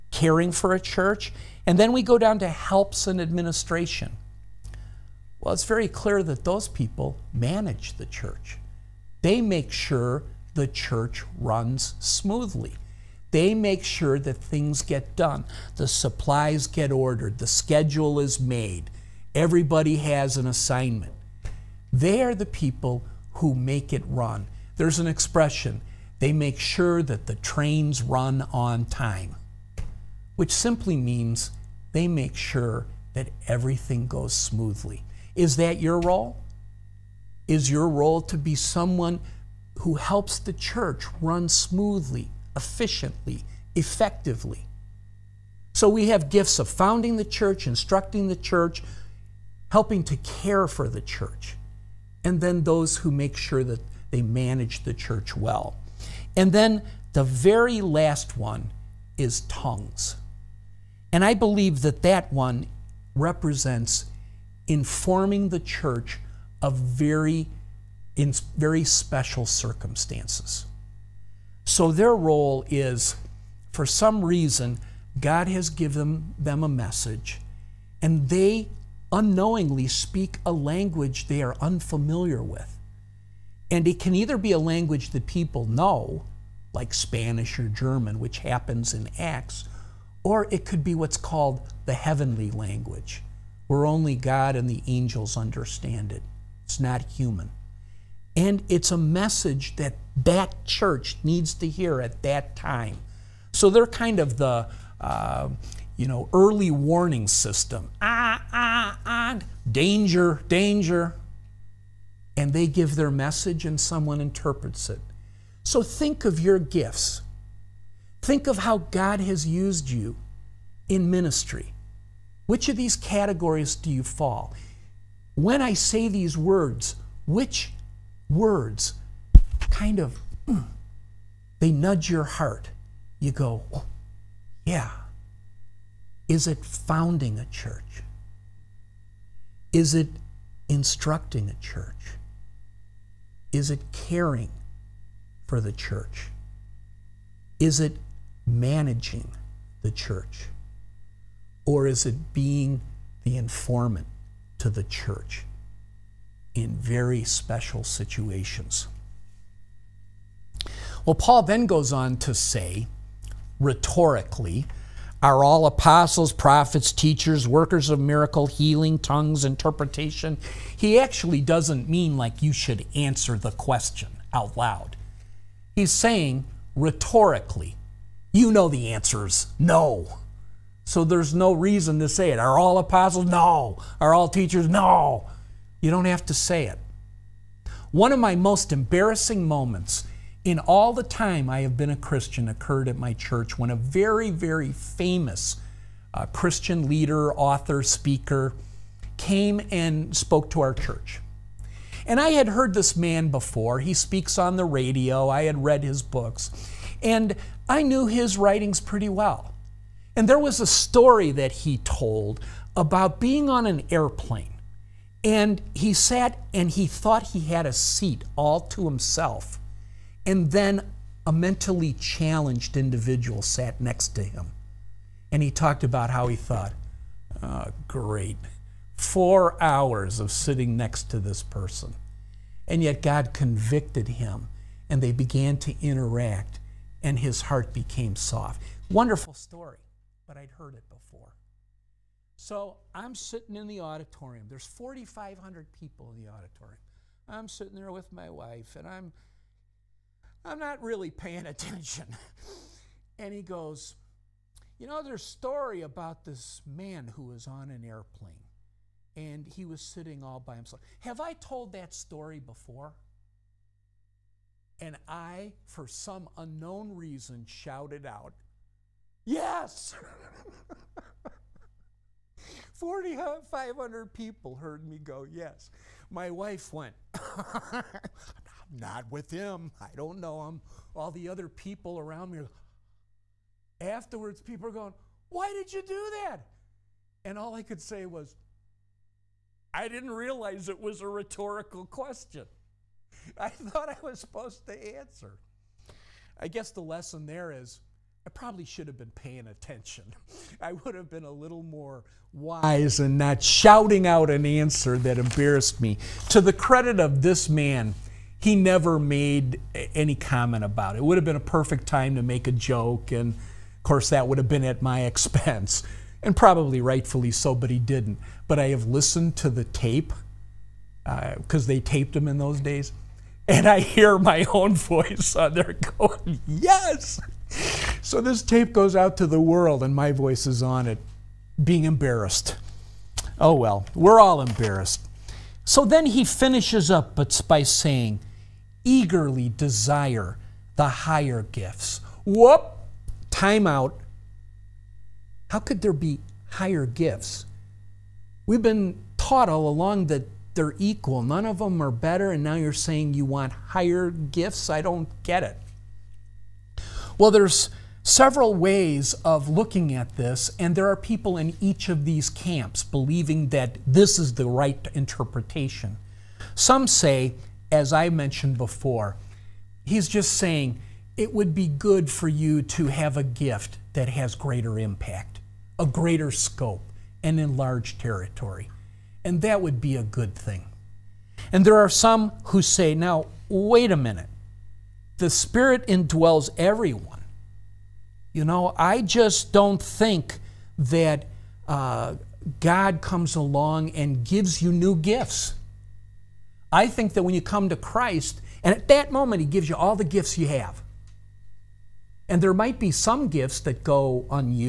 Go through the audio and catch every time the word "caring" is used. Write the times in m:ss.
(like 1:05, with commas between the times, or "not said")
0:00, 2:23.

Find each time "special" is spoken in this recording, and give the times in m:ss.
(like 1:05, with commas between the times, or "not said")
1:08, 2:37.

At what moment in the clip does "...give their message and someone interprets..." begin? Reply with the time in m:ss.
1:52.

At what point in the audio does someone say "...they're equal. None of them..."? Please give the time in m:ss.
5:50.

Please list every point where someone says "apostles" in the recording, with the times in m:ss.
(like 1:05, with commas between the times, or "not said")
2:45, 3:02.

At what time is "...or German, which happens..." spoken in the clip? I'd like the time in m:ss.
1:27.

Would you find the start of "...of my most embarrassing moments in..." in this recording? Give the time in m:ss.
3:08.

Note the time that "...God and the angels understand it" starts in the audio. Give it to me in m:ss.
1:34.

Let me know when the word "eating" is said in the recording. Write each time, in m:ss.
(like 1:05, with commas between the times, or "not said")
not said.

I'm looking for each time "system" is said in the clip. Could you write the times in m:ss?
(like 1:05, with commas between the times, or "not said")
1:47.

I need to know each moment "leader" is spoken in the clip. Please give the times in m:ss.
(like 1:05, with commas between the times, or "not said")
3:16.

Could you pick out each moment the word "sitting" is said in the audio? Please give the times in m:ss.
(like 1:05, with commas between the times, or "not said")
3:50, 4:03, 4:07, 4:19.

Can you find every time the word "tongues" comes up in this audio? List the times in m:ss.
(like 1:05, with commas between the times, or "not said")
0:59, 2:48.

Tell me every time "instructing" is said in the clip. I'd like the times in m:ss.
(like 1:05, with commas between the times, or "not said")
0:47, 2:20.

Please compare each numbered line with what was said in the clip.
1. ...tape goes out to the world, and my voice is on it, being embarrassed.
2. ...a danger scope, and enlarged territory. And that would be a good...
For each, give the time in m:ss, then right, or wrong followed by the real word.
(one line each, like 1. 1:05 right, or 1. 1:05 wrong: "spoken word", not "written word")
1. 5:28 right
2. 6:15 wrong: "greater", not "danger".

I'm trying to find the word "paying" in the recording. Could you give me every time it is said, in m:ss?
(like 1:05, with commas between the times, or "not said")
4:11, 4:59.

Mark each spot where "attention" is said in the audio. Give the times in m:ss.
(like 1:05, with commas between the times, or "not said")
4:11, 4:59.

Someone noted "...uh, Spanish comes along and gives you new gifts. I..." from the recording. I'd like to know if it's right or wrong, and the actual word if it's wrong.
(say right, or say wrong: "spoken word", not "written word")
wrong: "God", not "Spanish".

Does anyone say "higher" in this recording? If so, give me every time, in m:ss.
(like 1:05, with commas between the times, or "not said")
5:40, 5:46, 5:53.